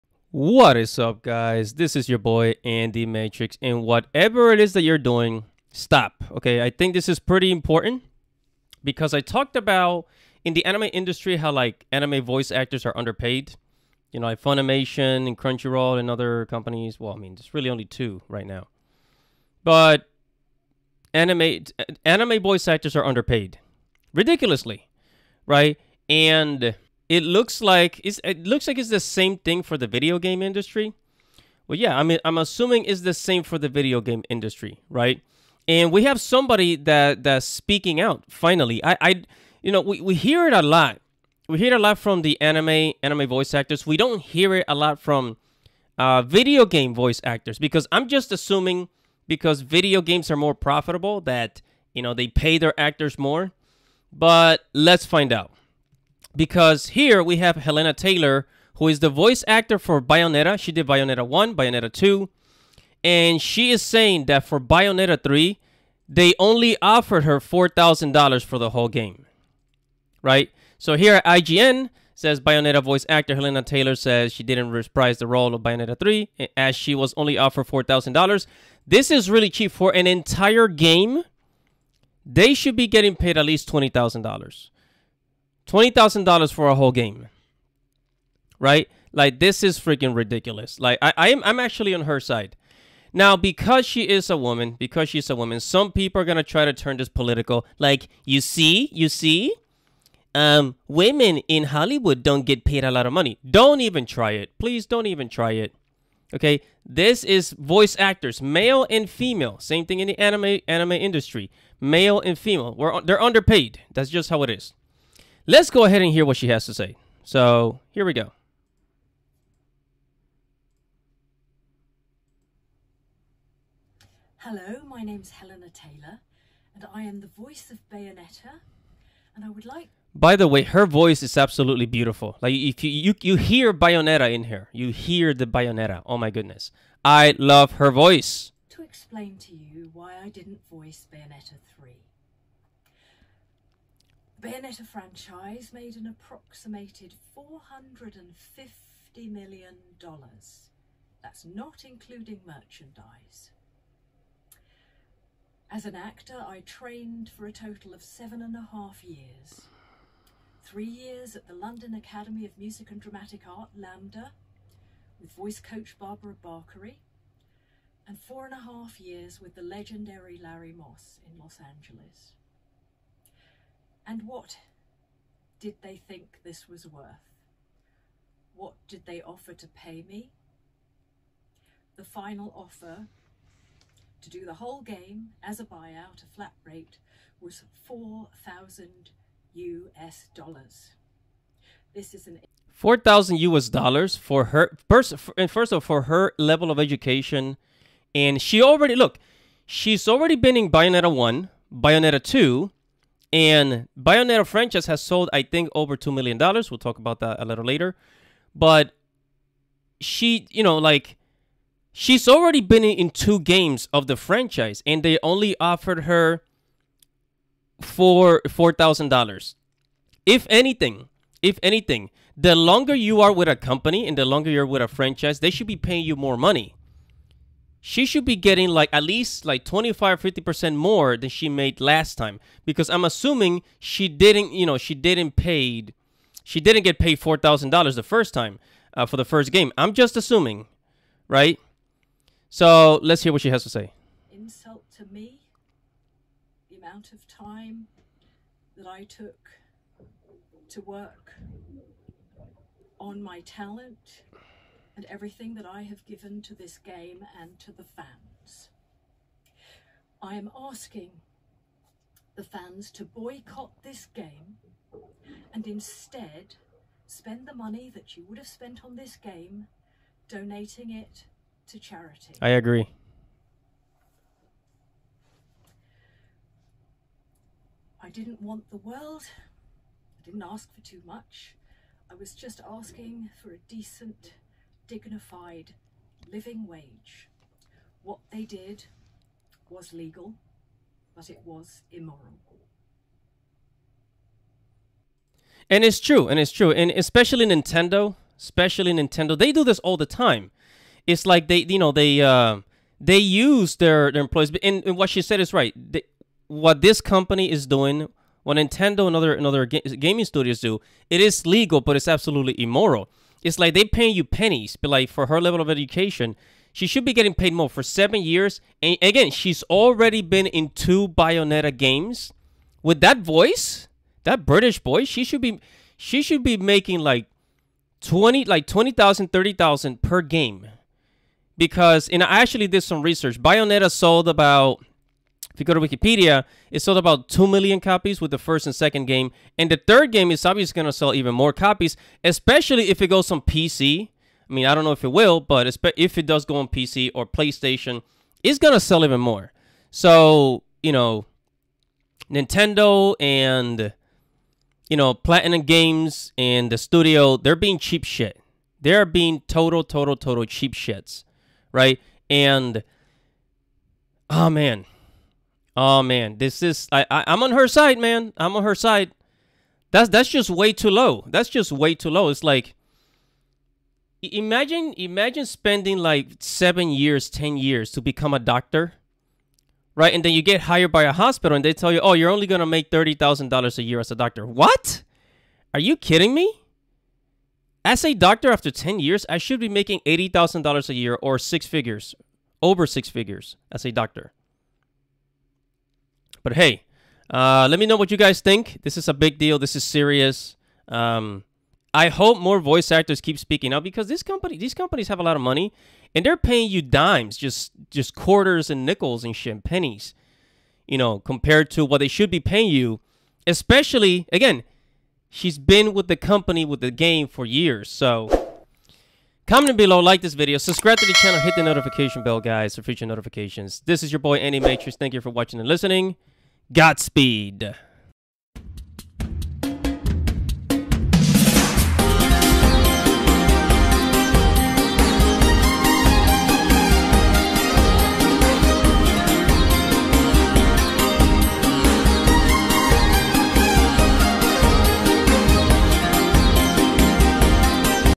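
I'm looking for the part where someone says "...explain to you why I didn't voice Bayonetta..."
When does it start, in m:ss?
2:18.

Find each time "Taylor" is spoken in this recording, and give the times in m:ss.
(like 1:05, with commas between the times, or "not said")
0:57, 1:13, 2:05.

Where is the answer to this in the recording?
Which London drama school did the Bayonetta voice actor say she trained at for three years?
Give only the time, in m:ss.
2:41.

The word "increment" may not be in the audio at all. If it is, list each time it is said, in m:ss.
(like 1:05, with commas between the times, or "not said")
not said.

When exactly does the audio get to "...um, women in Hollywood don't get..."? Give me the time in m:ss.
1:40.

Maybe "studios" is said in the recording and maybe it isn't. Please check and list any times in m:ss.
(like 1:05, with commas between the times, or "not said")
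5:10, 5:56.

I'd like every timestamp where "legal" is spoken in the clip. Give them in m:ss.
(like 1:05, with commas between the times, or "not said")
4:49, 5:11.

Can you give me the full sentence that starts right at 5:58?
They're being total, total, total cheap shits, right?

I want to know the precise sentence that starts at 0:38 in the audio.
Finally, I, I, you know, we, we hear it a lot.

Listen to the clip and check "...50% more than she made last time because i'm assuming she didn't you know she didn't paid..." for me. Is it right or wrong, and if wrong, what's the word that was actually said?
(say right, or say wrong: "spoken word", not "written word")
right.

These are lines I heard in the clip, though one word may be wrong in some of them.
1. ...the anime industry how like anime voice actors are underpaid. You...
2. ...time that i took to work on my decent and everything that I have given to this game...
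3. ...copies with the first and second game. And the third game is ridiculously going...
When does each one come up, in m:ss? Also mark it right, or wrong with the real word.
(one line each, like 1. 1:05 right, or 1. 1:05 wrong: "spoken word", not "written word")
1. 0:10 right
2. 4:07 wrong: "talent", not "decent"
3. 5:37 wrong: "obviously", not "ridiculously".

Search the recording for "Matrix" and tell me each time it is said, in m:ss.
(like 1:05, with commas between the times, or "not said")
0:03, 7:04.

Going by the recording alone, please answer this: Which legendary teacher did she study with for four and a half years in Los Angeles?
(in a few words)
Larry Moss.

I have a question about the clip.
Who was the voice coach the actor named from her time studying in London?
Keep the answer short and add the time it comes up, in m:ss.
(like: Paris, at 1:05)
Barbara Barkery, at 2:45.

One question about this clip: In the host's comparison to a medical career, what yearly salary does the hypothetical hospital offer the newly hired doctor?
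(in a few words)
$30,000.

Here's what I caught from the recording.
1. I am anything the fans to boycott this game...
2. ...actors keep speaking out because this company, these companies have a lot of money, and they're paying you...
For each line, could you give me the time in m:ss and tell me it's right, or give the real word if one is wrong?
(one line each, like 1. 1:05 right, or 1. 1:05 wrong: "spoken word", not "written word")
1. 4:20 wrong: "asking", not "anything"
2. 6:42 right.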